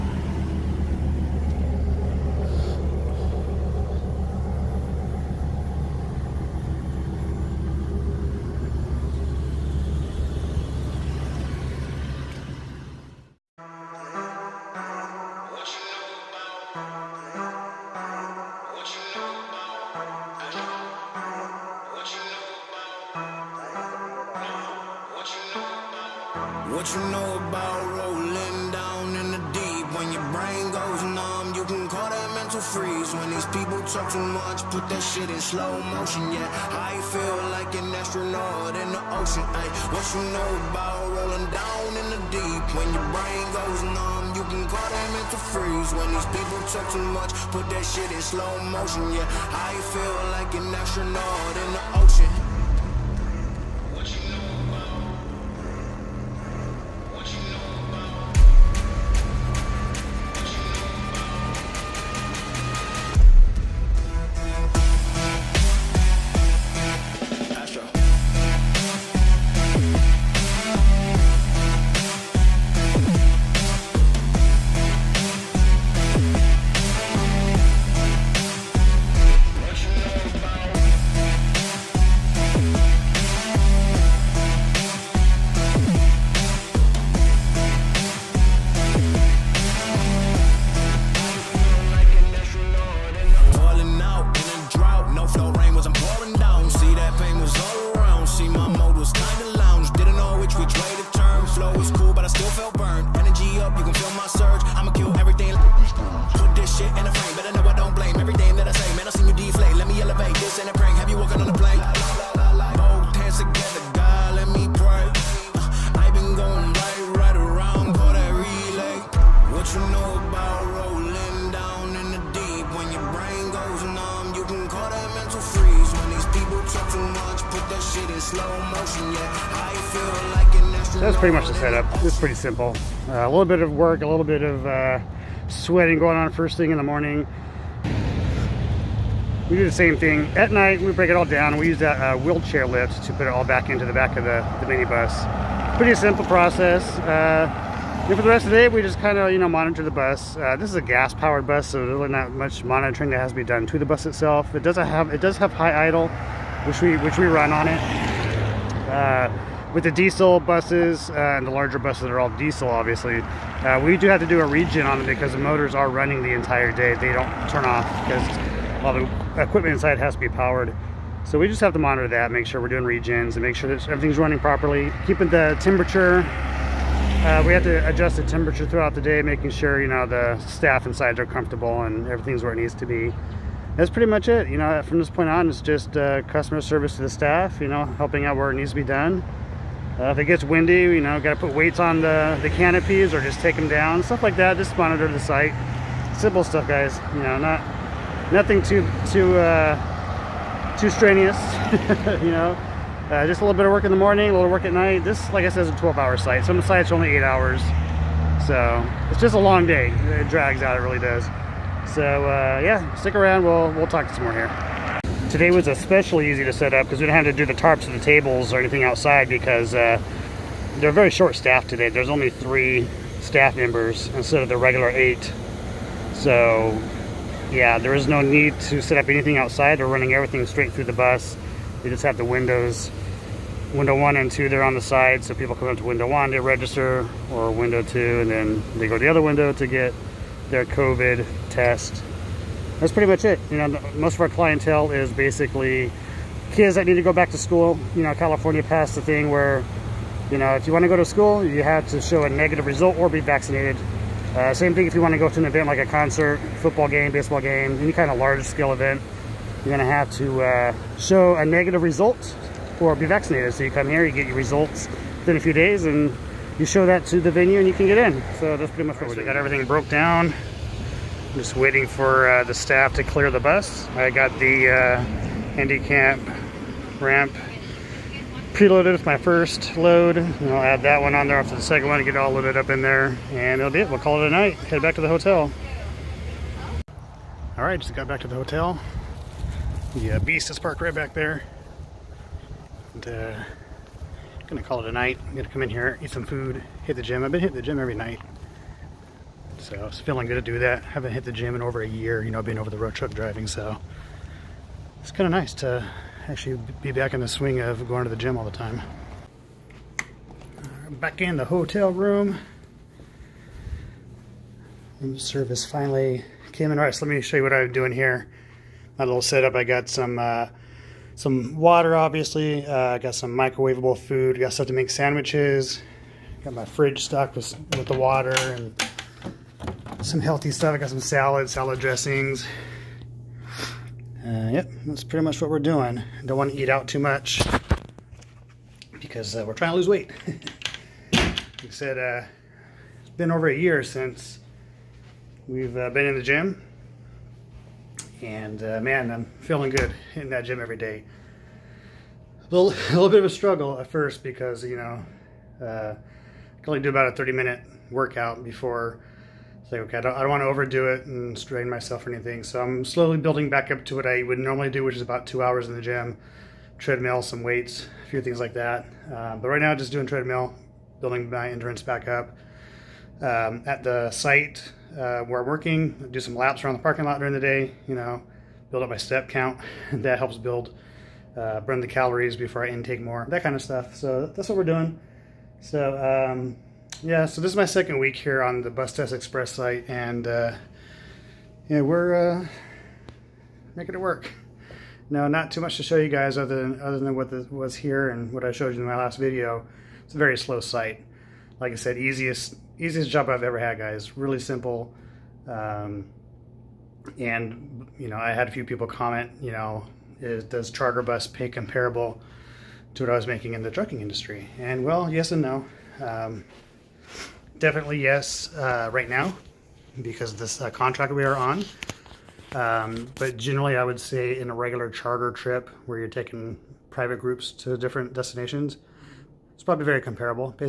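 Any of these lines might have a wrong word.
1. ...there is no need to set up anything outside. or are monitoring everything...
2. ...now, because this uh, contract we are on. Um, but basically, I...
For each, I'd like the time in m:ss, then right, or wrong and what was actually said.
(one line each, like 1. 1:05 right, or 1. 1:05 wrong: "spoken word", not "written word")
1. 3:47 wrong: "running", not "monitoring"
2. 6:59 wrong: "generally", not "basically".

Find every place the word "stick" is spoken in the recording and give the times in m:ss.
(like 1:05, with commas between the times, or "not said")
3:32.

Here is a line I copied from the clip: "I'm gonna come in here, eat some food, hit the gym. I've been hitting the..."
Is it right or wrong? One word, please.
right.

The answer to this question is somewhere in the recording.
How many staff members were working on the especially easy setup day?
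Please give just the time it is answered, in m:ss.
3:42.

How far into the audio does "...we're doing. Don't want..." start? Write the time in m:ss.
5:35.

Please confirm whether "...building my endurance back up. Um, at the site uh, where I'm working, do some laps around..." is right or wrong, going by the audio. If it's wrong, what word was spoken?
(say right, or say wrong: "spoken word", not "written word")
right.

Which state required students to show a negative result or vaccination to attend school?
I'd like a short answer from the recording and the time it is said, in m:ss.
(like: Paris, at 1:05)
California, at 4:08.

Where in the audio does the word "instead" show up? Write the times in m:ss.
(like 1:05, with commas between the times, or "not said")
3:44.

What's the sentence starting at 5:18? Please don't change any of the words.
My little setup, I got some uh, some water, obviously.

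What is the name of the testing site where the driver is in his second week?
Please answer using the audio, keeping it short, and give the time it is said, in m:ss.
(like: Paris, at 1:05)
Bus Test Express, at 6:28.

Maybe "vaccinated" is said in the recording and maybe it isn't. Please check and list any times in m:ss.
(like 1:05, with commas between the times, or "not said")
4:13, 4:23.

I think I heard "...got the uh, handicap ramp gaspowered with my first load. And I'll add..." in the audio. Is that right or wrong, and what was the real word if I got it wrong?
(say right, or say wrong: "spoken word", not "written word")
wrong: "preloaded", not "gaspowered".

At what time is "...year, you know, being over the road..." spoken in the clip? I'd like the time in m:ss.
5:01.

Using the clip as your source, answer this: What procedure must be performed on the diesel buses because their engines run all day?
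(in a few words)
Regen.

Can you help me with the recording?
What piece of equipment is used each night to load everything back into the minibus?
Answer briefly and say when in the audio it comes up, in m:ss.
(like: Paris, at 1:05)
Wheelchair lift, at 2:22.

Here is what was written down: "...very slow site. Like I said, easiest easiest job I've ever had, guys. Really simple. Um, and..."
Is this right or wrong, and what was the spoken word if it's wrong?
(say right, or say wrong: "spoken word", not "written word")
right.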